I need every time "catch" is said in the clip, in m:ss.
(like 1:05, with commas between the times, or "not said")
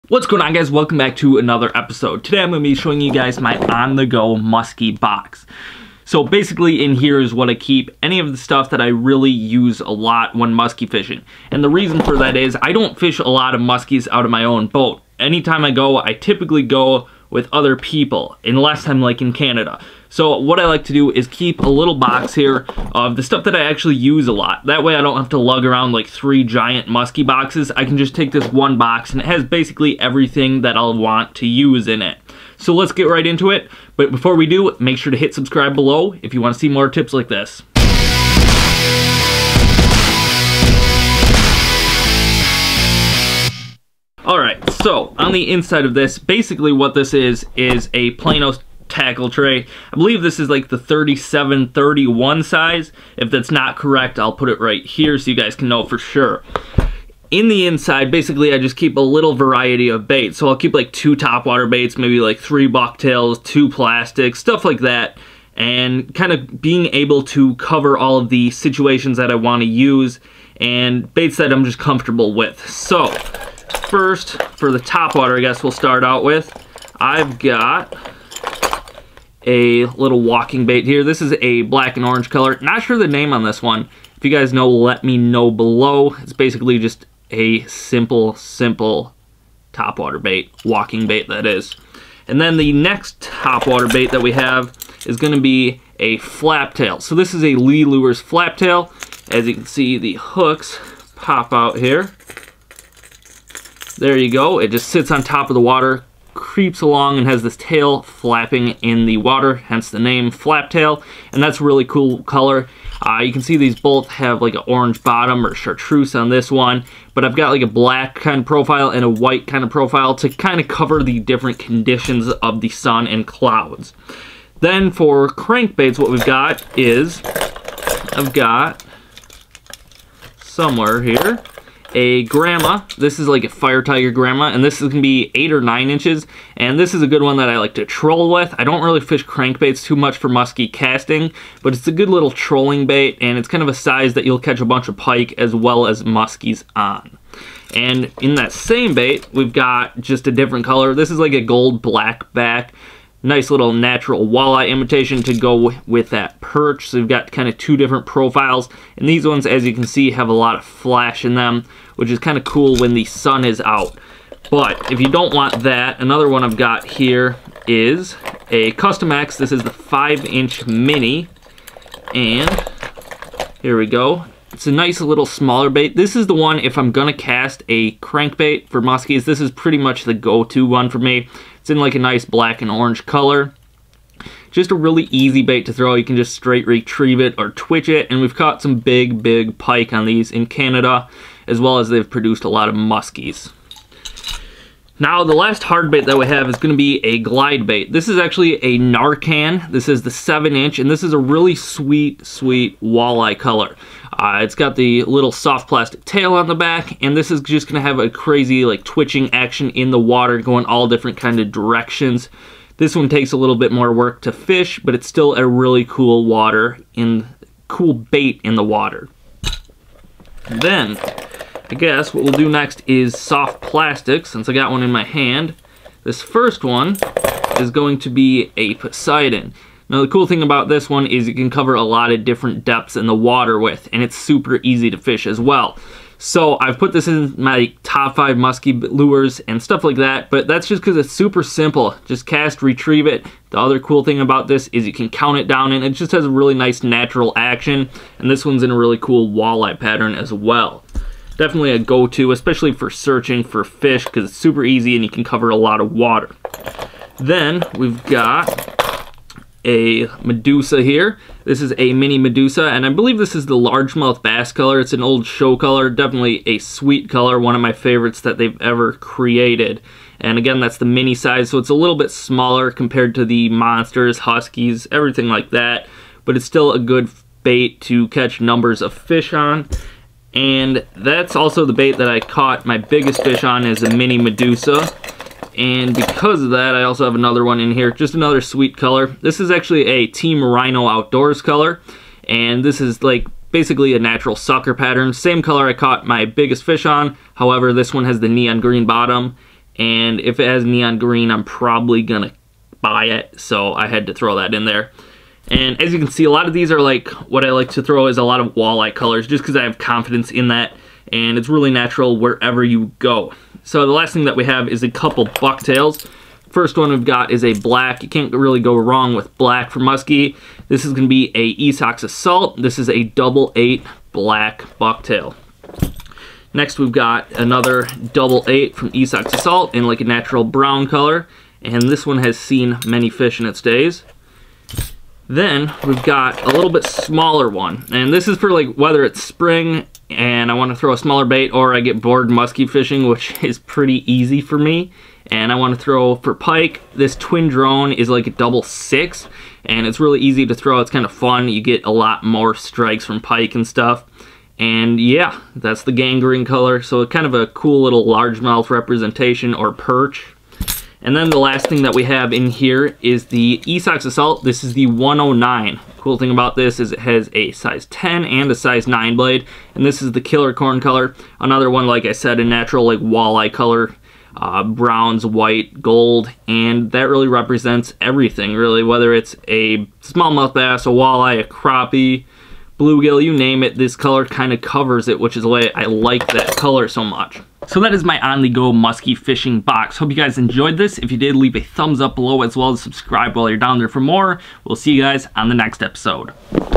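2:24, 4:38.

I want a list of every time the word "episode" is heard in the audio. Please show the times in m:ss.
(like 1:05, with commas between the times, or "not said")
0:01, 6:35.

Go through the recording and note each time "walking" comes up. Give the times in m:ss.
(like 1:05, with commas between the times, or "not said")
1:20, 1:30.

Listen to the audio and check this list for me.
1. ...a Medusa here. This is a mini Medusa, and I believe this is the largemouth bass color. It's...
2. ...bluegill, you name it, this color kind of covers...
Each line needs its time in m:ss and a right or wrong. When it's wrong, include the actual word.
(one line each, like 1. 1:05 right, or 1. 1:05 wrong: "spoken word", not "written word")
1. 4:19 right
2. 6:22 right.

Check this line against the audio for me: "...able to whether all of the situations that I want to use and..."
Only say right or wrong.
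wrong.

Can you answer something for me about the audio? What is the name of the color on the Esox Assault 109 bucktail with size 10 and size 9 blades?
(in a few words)
killer corn.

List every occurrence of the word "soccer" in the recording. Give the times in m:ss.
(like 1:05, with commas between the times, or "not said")
not said.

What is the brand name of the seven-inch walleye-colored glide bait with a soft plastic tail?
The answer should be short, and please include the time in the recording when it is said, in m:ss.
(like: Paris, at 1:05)
Narcan, at 3:18.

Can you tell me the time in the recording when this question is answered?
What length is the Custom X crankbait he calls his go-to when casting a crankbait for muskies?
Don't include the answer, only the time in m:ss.
2:49.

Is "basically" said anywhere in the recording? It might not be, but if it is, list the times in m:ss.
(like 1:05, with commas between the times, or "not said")
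0:06, 0:29, 0:46, 0:58, 1:26, 4:53.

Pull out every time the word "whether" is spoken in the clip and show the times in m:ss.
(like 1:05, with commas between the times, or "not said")
5:38, 6:18.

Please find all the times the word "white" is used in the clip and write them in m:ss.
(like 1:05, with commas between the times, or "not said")
1:59, 6:15.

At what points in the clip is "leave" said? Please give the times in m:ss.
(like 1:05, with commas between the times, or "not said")
6:31.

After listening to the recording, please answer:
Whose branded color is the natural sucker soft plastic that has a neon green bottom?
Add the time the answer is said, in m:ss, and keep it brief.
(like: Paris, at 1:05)
Team Rhino Outdoors, at 4:50.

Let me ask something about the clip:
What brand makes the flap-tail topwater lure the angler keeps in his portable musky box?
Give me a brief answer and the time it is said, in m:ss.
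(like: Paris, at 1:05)
Lee Lures, at 1:37.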